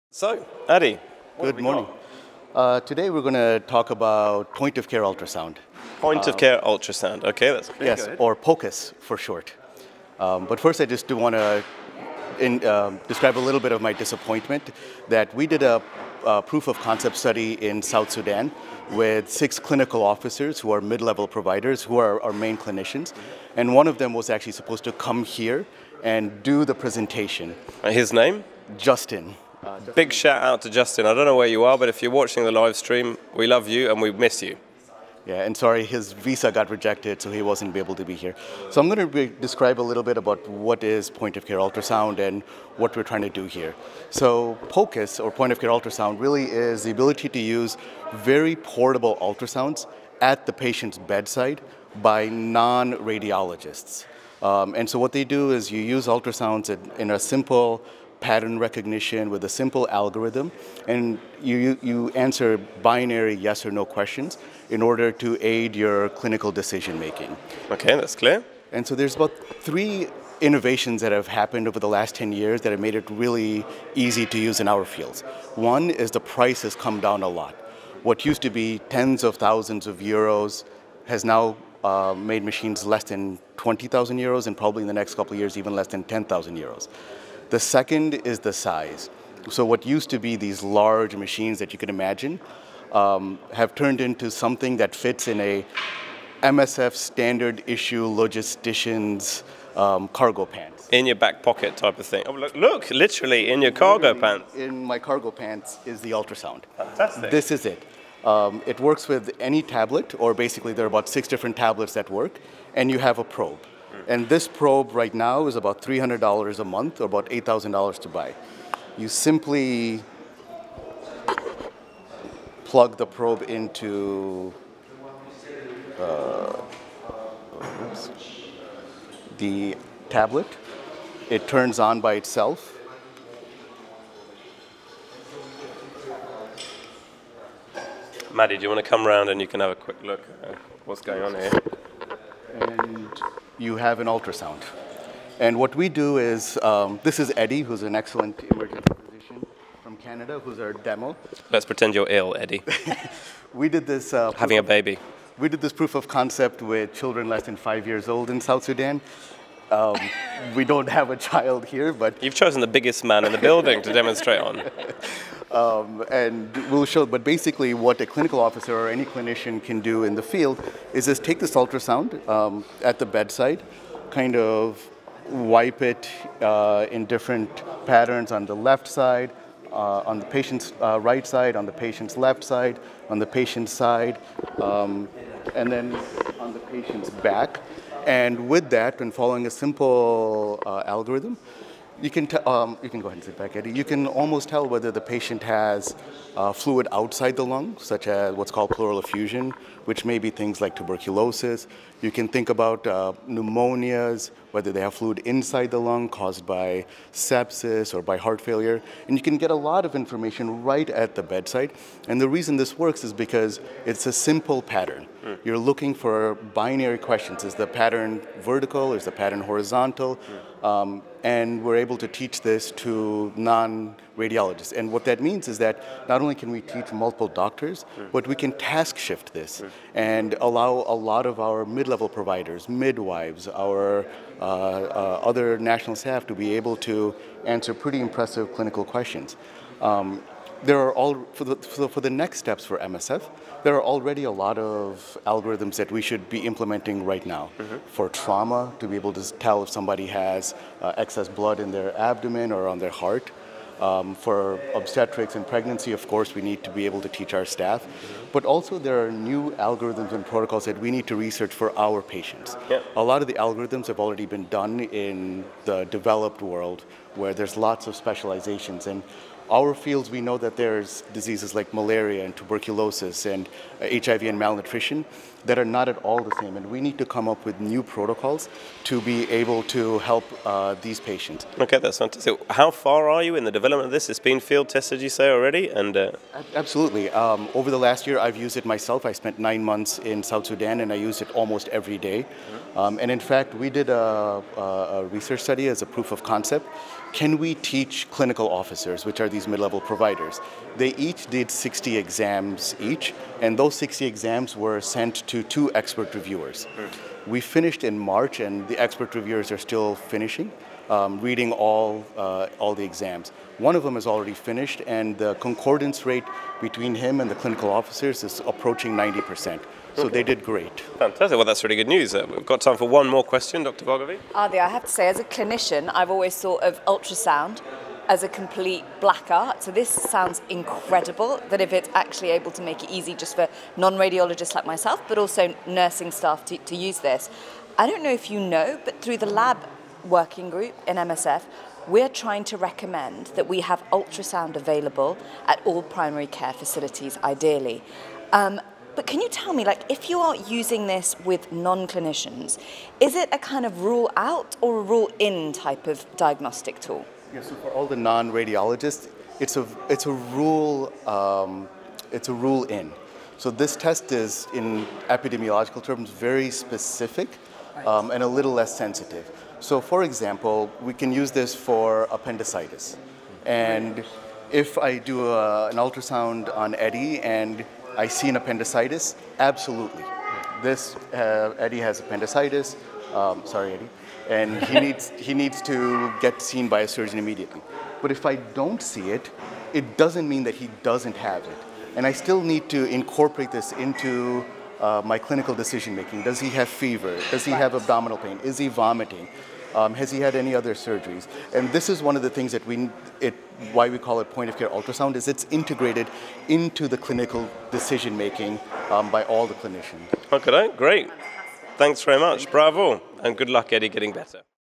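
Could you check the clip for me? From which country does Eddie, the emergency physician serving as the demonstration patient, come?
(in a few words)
Canada.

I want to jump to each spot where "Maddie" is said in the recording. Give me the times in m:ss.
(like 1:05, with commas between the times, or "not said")
2:18.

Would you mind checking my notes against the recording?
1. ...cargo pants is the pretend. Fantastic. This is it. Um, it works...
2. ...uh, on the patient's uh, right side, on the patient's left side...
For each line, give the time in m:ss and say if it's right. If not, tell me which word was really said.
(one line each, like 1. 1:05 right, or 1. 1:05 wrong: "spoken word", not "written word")
1. 1:44 wrong: "ultrasound", not "pretend"
2. 2:59 right.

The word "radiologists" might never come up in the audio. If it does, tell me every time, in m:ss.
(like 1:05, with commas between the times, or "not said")
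0:52, 3:43, 5:33, 5:57.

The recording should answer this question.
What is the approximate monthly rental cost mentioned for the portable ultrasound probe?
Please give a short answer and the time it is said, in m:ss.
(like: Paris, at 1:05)
$300, at 1:55.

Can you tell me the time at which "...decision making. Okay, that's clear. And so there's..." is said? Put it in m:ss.
1:06.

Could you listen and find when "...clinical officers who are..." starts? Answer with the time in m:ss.
0:19.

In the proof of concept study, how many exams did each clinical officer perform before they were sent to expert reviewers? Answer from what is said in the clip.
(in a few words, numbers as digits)
60.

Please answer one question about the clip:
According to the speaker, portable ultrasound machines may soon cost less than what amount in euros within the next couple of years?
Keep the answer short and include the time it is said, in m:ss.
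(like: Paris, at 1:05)
10,000 euros, at 1:25.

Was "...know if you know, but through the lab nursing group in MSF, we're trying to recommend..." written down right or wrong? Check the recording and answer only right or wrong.
wrong.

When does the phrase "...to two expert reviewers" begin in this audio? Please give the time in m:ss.
5:05.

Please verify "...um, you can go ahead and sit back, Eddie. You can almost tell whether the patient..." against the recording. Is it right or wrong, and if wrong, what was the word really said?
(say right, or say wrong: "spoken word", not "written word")
right.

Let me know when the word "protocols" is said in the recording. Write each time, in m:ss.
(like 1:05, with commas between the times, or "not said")
4:20, 4:37.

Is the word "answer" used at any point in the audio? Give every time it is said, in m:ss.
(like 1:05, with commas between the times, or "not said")
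1:02, 3:57.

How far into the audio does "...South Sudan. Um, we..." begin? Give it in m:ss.
2:38.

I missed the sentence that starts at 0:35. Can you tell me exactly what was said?
Yeah, and sorry, his visa got rejected, so he wasn't able to be here.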